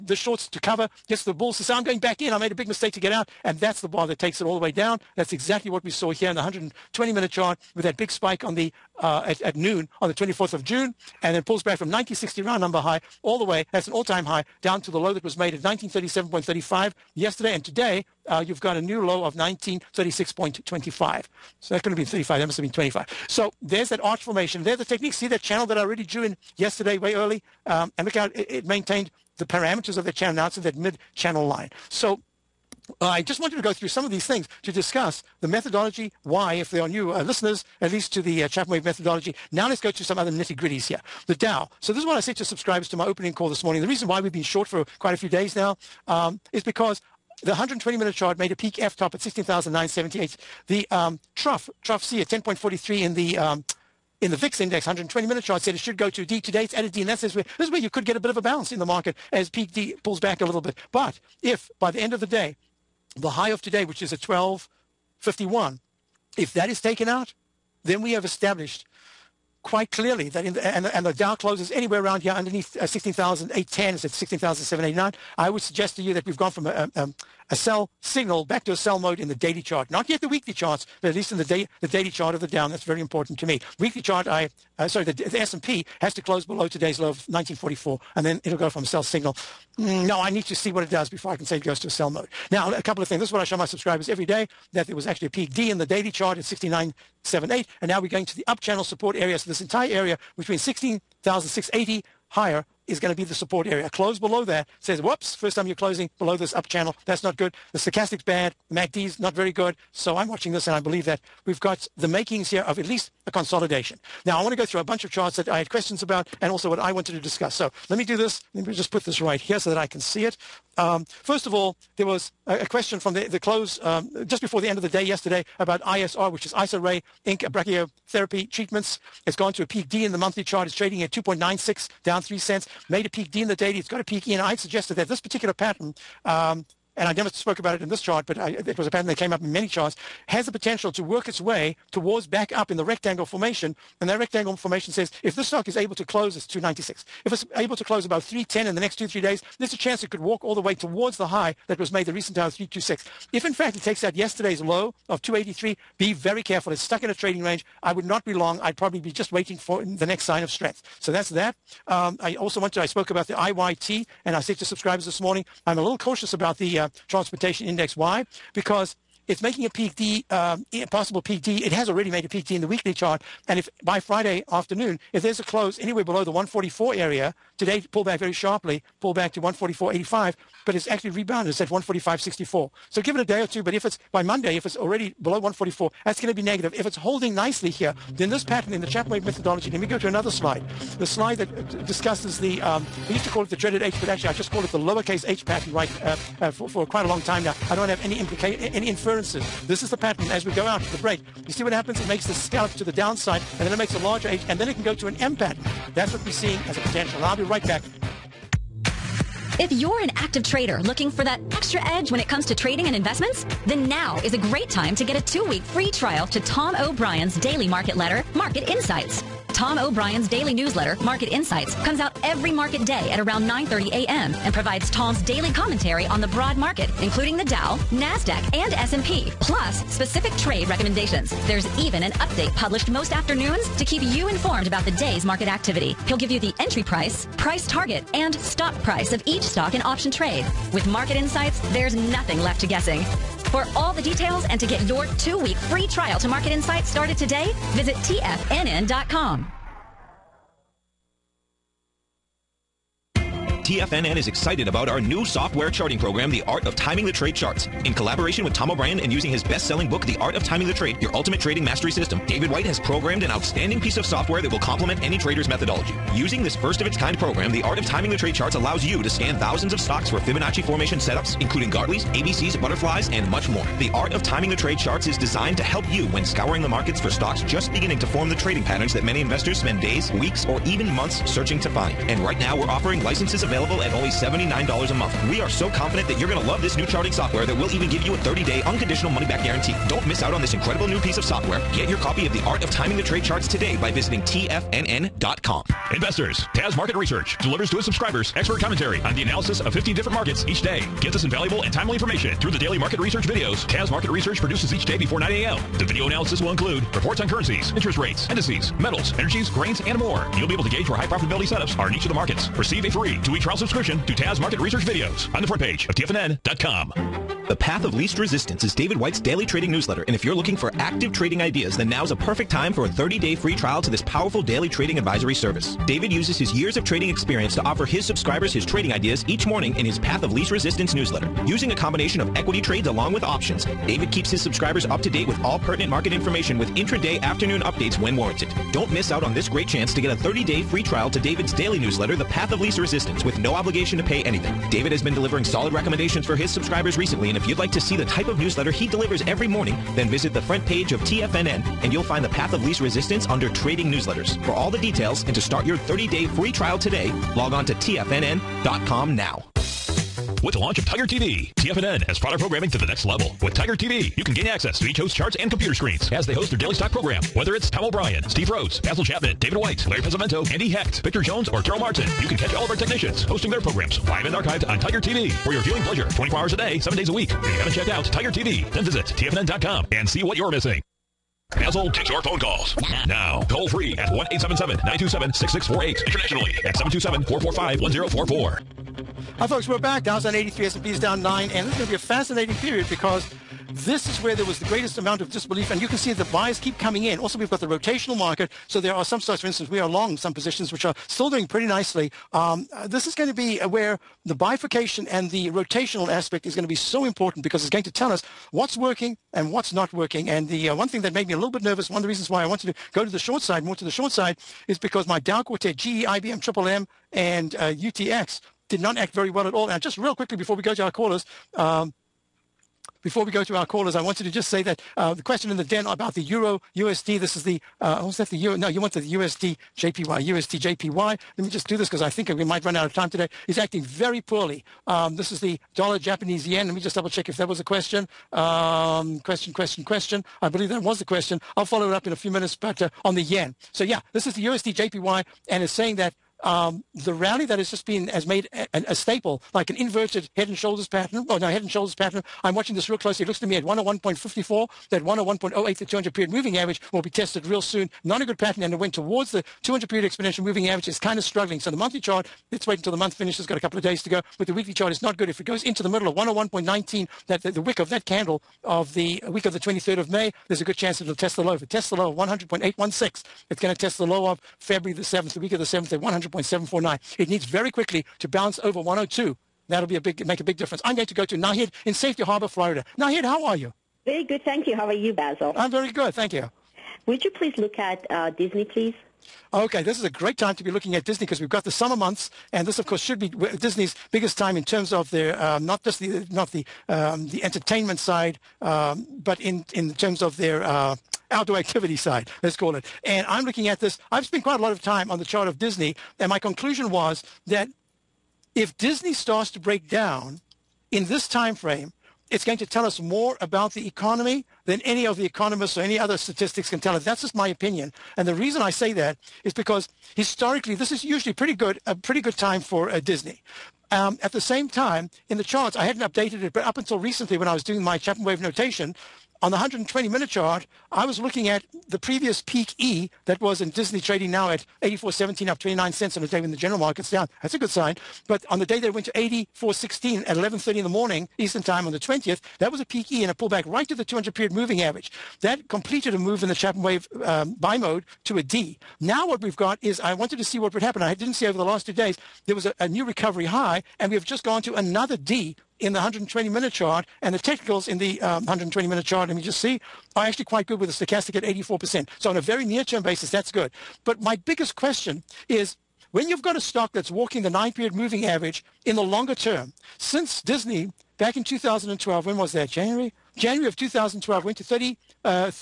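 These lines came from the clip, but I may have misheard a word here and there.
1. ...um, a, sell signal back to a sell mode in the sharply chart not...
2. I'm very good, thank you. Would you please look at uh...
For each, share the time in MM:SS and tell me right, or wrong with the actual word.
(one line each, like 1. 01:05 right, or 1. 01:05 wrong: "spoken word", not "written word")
1. 01:17 wrong: "daily", not "sharply"
2. 08:05 right.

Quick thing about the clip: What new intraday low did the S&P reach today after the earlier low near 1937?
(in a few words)
1936.25.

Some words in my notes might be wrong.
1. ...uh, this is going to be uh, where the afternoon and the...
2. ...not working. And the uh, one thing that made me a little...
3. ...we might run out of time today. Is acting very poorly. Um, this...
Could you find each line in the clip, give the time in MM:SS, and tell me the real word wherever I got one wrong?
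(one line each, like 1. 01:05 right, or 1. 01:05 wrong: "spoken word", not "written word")
1. 06:42 wrong: "bifurcation", not "afternoon"
2. 06:49 right
3. 07:12 right.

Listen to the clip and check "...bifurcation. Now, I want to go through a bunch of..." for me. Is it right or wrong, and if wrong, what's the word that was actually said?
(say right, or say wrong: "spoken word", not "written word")
wrong: "consolidation", not "bifurcation".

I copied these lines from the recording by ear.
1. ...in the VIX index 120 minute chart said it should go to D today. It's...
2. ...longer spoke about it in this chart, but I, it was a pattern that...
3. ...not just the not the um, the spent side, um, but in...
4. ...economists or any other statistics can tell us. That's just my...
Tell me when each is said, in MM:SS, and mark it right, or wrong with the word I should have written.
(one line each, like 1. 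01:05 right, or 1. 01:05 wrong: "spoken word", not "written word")
1. 00:54 right
2. 02:17 wrong: "never", not "longer"
3. 08:15 wrong: "entertainment", not "spent"
4. 08:35 right.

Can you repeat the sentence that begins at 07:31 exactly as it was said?
Oh no, head and shoulders pattern.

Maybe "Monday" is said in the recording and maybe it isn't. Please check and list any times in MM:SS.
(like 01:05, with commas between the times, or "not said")
03:04.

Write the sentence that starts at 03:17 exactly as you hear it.
I don't have any implica any inferences.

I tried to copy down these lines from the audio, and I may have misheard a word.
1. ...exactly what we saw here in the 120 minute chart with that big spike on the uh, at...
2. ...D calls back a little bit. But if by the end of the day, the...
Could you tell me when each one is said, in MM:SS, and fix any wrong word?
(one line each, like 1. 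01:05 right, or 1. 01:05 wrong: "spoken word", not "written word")
1. 00:05 right
2. 00:59 wrong: "pulls", not "calls".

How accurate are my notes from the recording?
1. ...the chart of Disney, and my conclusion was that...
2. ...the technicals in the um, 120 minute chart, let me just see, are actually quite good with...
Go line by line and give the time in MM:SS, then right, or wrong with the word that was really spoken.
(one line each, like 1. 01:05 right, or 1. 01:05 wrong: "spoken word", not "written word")
1. 08:25 right
2. 09:17 right.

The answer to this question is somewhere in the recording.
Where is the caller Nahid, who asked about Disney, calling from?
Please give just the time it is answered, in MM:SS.
08:01.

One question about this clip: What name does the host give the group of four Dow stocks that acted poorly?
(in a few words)
Dow Quartet.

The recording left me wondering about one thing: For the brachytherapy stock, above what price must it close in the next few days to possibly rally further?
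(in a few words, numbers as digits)
310.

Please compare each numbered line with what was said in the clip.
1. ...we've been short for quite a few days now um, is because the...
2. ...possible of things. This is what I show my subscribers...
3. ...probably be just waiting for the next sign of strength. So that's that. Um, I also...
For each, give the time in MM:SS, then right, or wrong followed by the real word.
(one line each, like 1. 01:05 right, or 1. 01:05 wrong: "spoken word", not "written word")
1. 00:44 right
2. 01:32 wrong: "couple", not "possible"
3. 02:38 right.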